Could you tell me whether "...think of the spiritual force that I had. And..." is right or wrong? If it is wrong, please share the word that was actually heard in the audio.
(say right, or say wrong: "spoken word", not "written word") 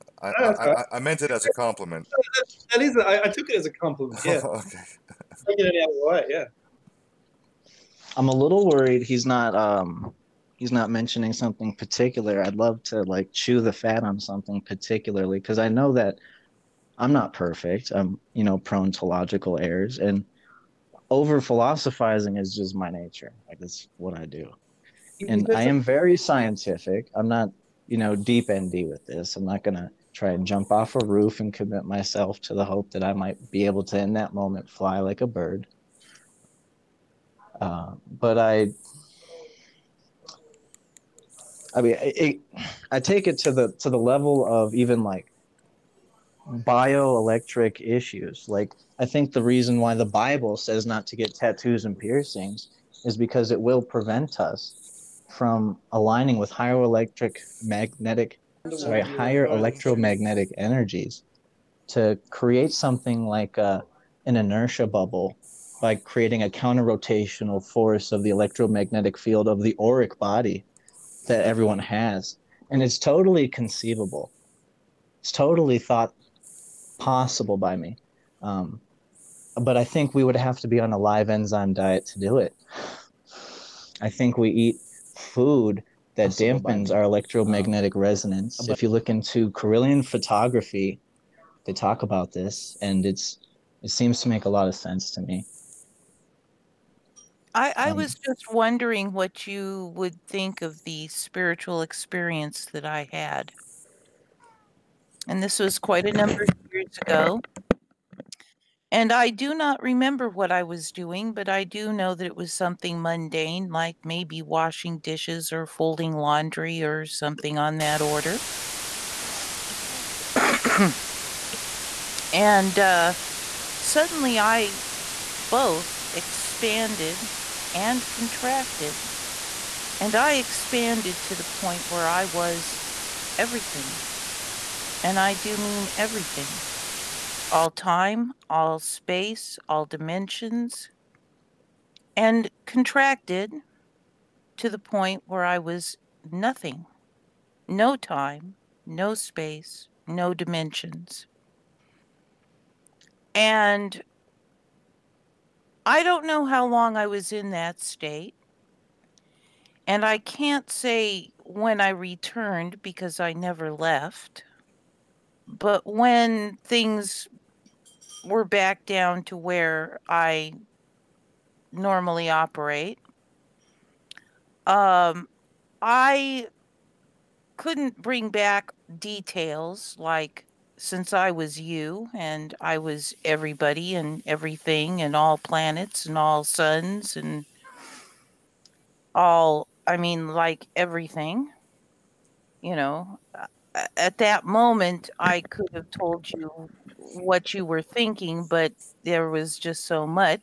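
wrong: "experience", not "force".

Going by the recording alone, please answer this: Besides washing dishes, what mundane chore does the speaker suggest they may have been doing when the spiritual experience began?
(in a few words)
Folding laundry.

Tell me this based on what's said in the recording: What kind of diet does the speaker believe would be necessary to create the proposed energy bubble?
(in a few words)
Live enzyme diet.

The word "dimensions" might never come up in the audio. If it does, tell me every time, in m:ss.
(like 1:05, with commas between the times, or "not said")
2:19, 2:30.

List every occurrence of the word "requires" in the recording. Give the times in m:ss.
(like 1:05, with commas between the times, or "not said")
not said.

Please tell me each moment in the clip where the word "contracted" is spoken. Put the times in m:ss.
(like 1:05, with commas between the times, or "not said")
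2:08, 2:22.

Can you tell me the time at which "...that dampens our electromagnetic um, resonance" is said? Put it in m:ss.
1:26.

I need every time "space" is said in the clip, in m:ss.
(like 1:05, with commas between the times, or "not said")
2:18, 2:29.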